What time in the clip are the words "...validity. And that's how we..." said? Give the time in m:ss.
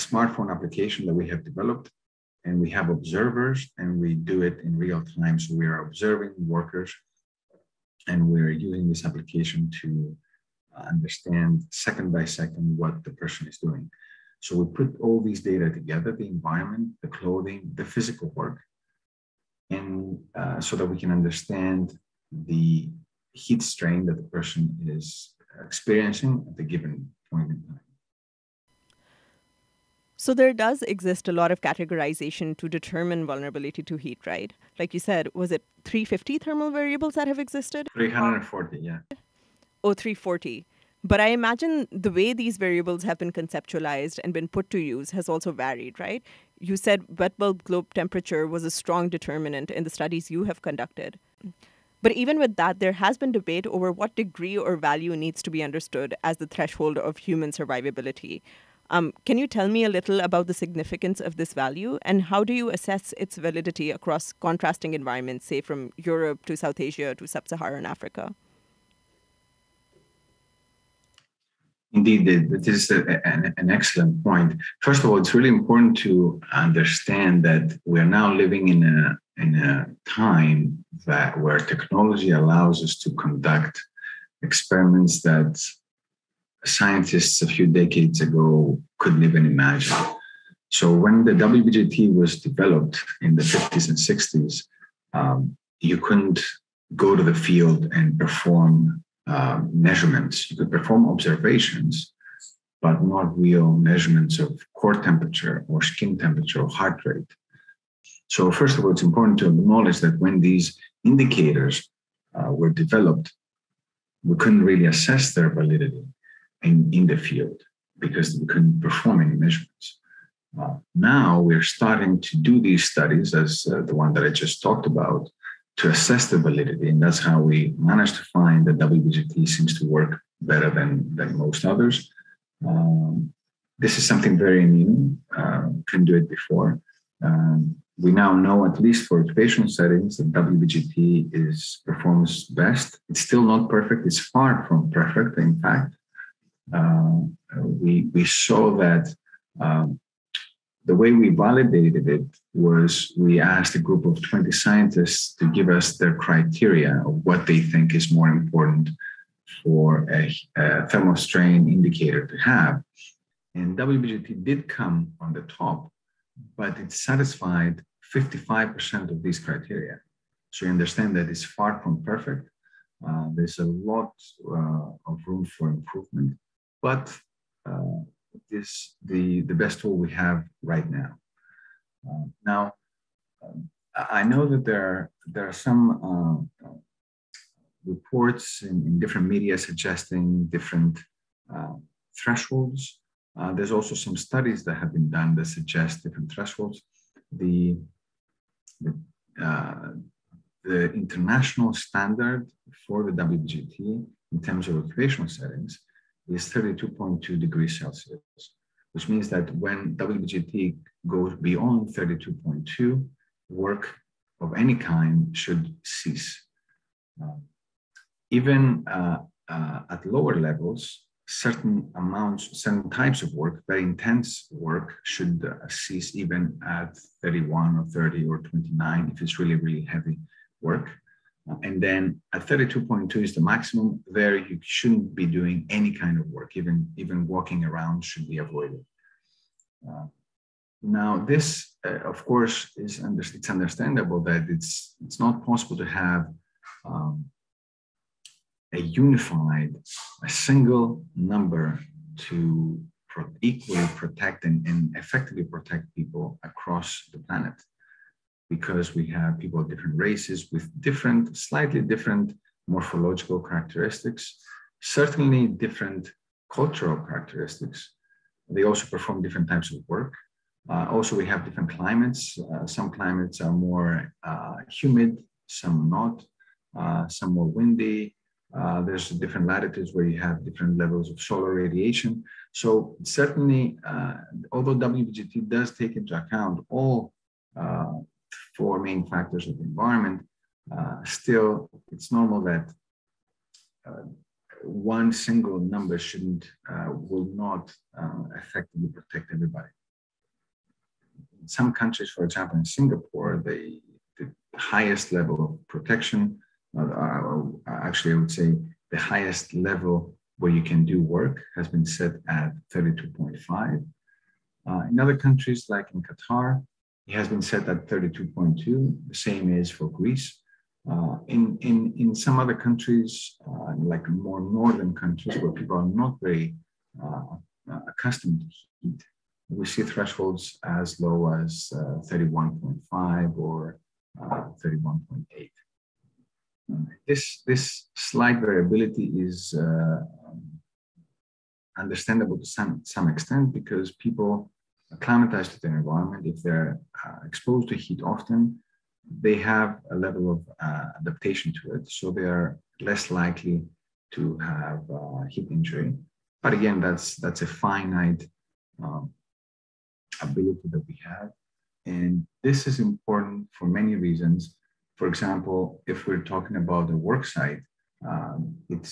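2:06.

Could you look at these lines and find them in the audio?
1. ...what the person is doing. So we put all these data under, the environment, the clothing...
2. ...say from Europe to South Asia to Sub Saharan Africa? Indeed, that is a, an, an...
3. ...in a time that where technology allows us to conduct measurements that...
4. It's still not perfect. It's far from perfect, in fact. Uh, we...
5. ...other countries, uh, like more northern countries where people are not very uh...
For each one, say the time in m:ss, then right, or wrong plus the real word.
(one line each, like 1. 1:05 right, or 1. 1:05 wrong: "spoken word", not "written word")
1. 0:12 wrong: "together", not "under"
2. 1:05 right
3. 1:19 wrong: "experiments", not "measurements"
4. 2:23 right
5. 5:22 right.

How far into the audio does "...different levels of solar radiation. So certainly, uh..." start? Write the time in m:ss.
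4:40.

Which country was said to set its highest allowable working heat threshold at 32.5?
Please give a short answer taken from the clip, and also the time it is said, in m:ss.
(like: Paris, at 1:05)
Singapore, at 5:02.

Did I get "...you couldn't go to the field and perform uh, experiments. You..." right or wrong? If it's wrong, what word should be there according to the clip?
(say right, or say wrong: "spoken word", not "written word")
wrong: "measurements", not "experiments".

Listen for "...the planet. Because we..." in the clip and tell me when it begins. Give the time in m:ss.
4:17.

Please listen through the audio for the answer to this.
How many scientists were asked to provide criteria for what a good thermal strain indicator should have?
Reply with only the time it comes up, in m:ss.
2:34.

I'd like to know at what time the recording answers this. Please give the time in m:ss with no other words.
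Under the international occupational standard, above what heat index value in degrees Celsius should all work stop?
3:26.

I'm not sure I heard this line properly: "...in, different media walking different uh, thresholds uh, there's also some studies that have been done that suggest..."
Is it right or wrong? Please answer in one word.
wrong.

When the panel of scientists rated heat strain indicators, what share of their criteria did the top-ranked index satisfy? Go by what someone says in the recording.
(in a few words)
55%.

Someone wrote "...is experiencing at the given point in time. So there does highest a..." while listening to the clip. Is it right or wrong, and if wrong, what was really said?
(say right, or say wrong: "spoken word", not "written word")
wrong: "exist", not "highest".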